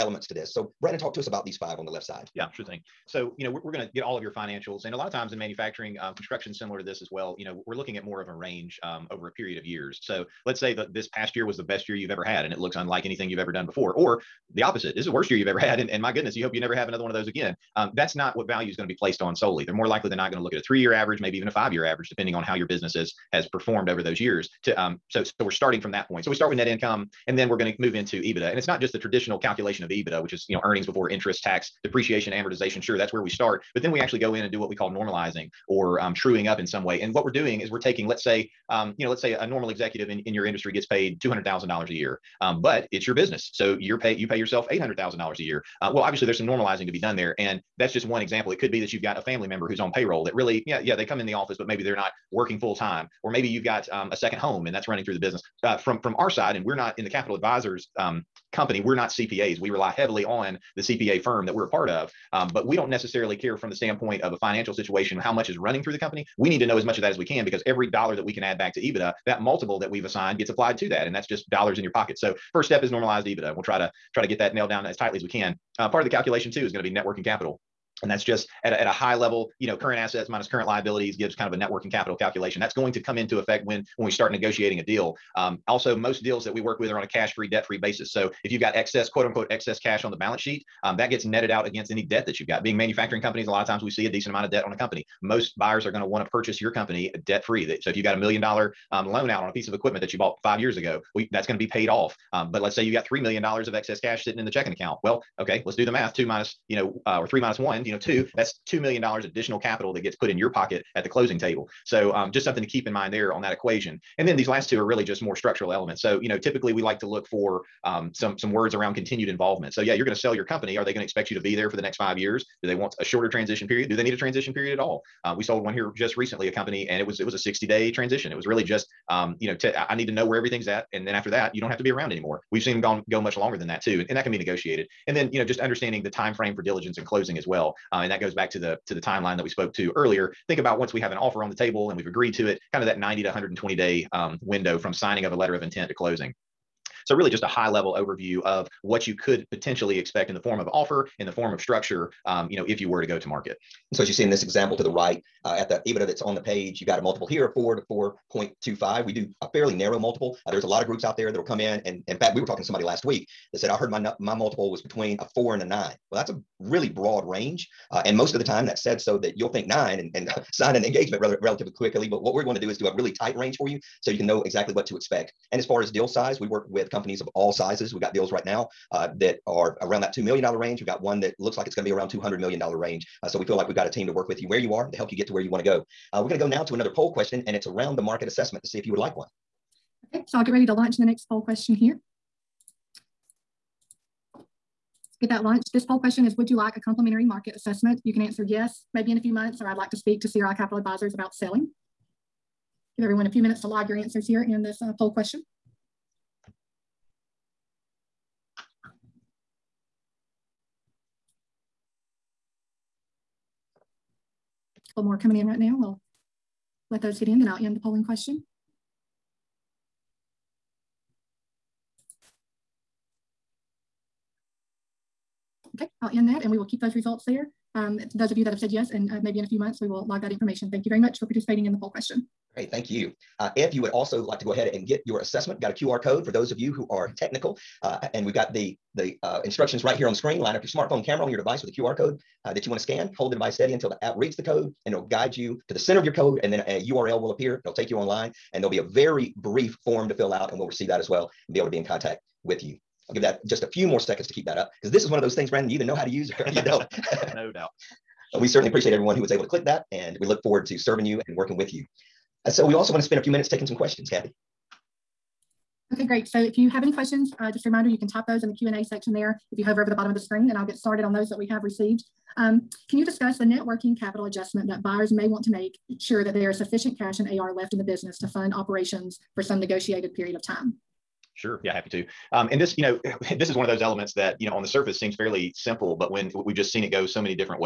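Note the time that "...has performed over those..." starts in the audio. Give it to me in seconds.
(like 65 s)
23 s.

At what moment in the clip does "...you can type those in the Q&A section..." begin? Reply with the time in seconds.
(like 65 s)
267 s.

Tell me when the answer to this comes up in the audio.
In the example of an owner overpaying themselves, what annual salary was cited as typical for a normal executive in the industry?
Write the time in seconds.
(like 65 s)
41 s.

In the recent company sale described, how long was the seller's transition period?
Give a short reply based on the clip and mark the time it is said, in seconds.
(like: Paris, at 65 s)
60 day, at 127 s.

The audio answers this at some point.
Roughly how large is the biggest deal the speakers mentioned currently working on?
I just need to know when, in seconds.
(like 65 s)
182 s.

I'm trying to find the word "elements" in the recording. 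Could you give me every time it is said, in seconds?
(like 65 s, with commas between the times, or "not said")
115 s, 283 s.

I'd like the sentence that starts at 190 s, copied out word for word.
Okay, so I'll get ready to launch the next poll question here.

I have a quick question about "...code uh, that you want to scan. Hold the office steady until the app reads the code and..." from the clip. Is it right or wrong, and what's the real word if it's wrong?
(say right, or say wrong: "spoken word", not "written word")
wrong: "device", not "office".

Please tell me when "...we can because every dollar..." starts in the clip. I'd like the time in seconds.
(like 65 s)
67 s.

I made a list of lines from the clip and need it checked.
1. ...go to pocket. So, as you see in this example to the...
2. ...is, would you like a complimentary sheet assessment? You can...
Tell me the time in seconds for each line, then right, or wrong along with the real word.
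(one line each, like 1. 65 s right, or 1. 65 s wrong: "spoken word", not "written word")
1. 153 s wrong: "market", not "pocket"
2. 196 s wrong: "market", not "sheet".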